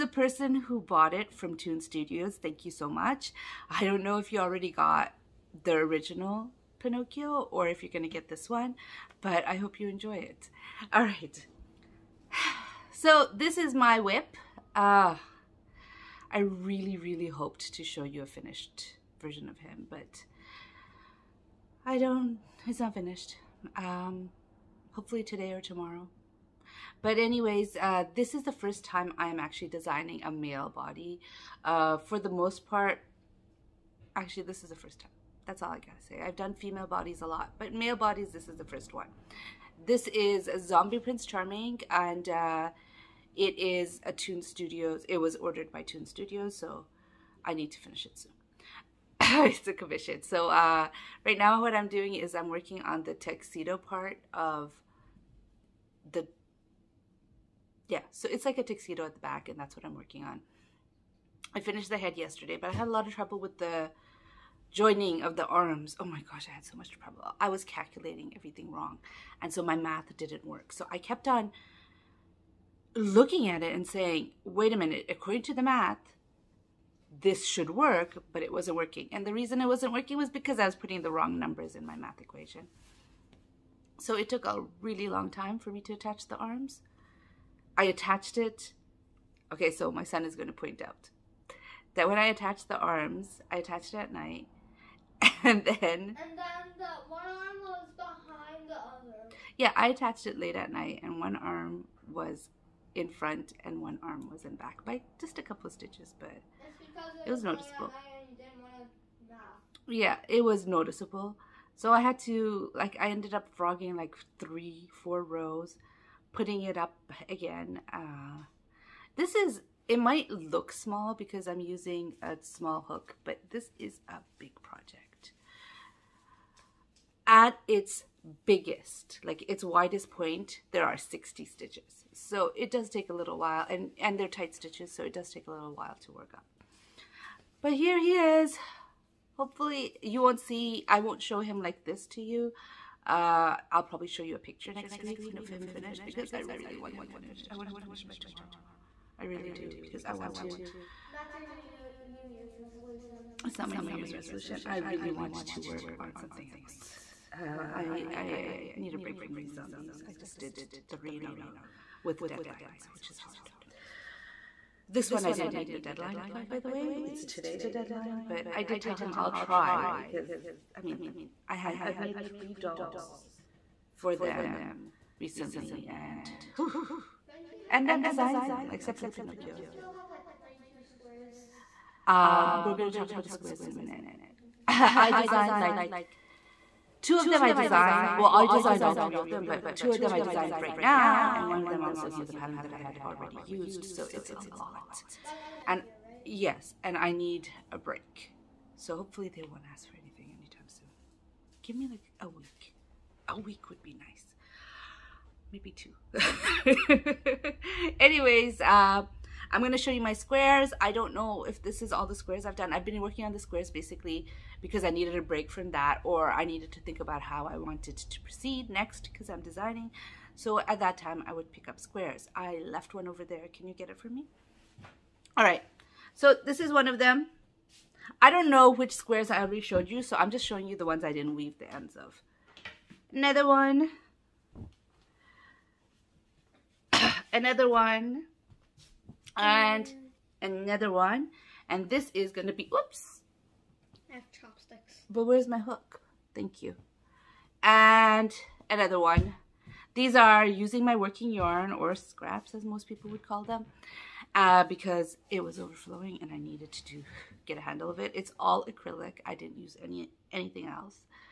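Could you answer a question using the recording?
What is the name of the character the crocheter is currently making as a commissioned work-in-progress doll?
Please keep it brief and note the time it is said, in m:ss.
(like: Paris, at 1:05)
Zombie Prince Charming, at 0:40.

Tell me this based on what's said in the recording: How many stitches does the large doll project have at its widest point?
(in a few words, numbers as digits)
60.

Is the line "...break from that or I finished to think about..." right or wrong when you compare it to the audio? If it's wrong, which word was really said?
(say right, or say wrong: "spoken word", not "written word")
wrong: "needed", not "finished".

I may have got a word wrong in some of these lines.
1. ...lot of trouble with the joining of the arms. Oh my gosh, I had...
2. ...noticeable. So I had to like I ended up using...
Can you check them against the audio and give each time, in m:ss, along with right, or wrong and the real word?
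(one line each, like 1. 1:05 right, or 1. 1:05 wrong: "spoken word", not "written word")
1. 1:02 right
2. 1:50 wrong: "frogging", not "using".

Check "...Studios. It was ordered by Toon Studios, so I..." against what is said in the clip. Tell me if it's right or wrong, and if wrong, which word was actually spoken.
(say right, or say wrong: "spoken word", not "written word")
right.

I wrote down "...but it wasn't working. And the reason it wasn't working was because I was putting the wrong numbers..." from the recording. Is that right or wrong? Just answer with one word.
right.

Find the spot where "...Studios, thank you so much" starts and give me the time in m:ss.
0:01.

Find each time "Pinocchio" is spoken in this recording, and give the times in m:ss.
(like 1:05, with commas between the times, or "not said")
0:06, 2:59.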